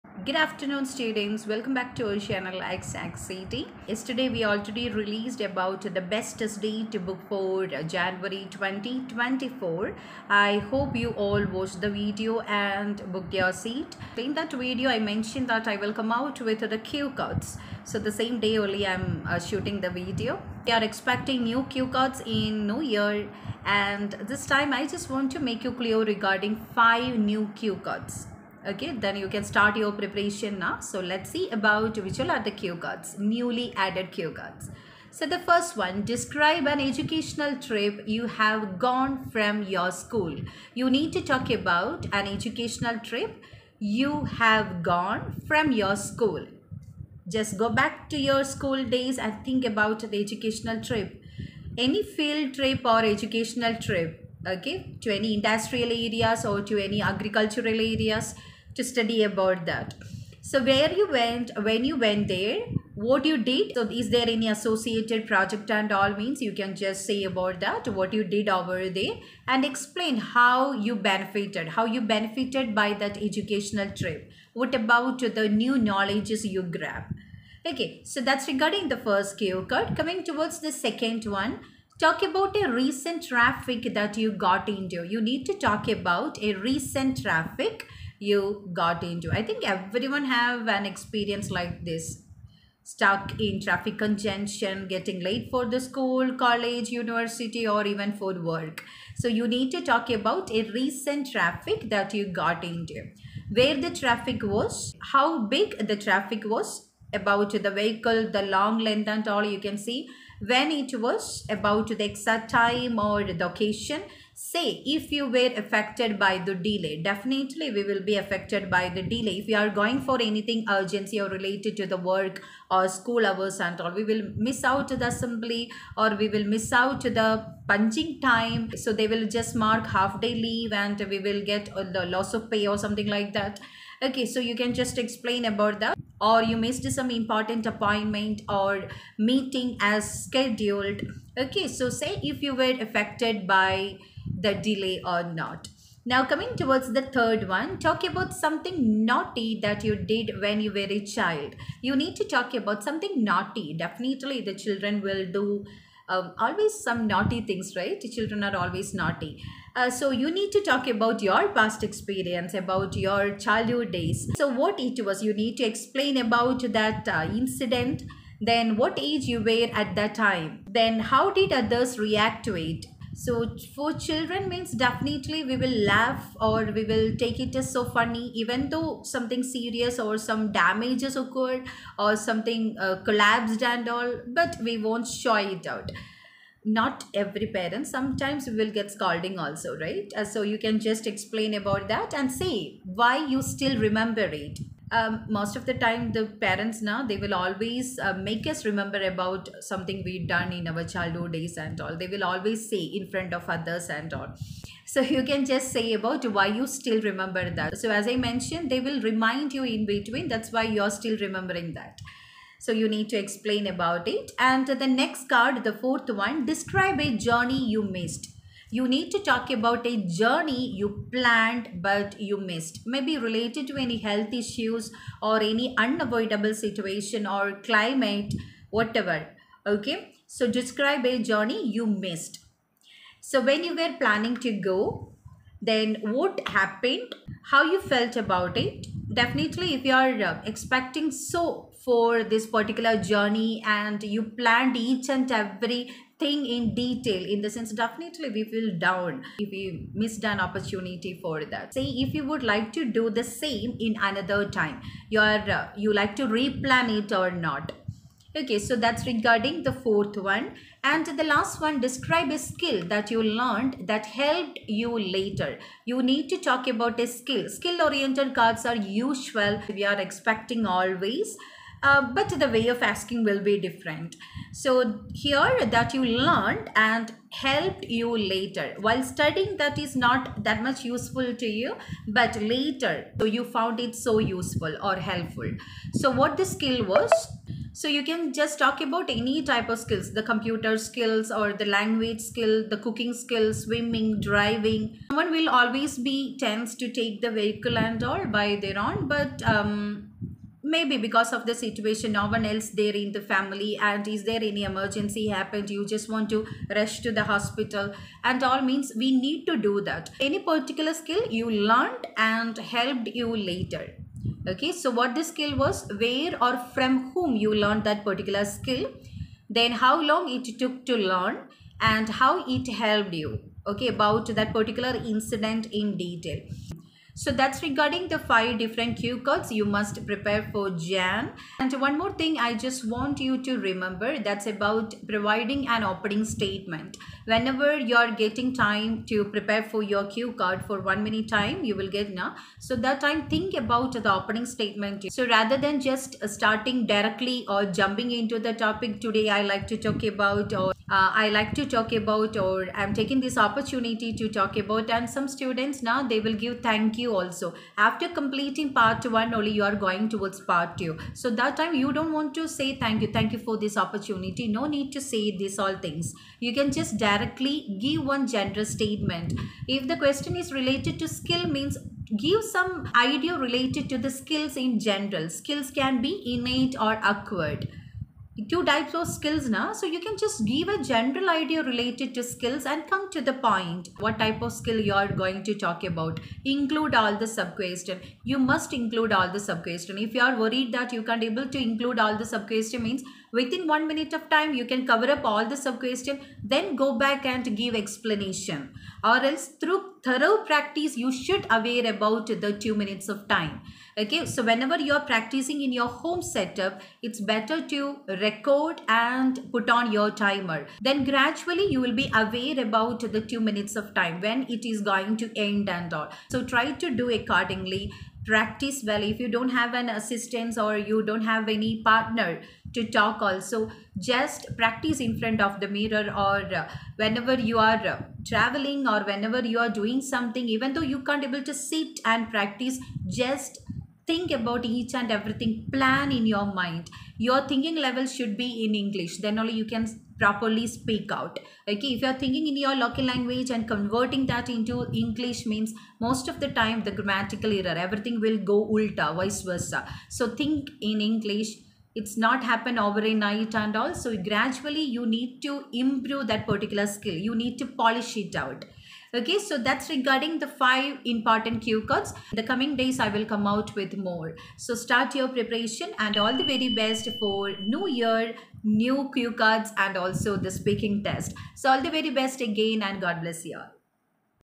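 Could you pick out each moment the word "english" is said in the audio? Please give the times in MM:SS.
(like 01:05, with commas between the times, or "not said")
07:18, 07:25, 07:31.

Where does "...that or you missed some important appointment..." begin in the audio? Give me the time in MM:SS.
02:15.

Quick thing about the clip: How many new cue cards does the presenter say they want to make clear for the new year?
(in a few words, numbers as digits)
5.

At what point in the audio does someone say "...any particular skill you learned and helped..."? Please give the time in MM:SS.
05:10.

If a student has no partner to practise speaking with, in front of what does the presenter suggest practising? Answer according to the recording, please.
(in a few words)
the mirror.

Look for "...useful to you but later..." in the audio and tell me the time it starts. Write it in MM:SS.
04:40.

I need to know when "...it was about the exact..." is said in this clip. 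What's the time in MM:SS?
01:50.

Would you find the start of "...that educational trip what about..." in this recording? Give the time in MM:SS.
01:12.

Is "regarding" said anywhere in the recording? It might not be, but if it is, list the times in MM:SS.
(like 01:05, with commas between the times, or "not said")
00:26, 01:18, 04:19, 05:27, 07:39.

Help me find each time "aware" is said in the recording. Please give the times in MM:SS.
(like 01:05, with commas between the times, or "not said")
06:41, 06:52.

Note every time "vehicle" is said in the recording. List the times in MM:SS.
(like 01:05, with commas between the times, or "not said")
01:47, 04:57.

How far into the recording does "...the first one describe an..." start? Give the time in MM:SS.
00:35.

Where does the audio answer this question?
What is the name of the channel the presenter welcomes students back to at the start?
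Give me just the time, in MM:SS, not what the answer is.
00:02.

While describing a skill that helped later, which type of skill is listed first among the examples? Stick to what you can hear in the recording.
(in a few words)
computer skills.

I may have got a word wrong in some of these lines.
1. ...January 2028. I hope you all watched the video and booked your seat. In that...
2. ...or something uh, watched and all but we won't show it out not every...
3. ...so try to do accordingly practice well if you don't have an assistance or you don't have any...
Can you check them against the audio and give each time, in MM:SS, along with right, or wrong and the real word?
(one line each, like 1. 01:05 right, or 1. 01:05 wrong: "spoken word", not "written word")
1. 00:07 wrong: "2024", not "2028"
2. 03:01 wrong: "collapsed", not "watched"
3. 06:56 right.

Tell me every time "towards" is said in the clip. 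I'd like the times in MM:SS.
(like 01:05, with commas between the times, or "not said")
01:20, 02:26, 06:00.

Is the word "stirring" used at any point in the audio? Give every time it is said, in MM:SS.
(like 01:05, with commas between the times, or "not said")
not said.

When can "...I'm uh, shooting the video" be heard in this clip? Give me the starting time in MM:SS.
00:18.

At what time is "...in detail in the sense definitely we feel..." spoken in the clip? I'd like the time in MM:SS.
04:06.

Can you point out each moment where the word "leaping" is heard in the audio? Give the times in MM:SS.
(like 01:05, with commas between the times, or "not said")
not said.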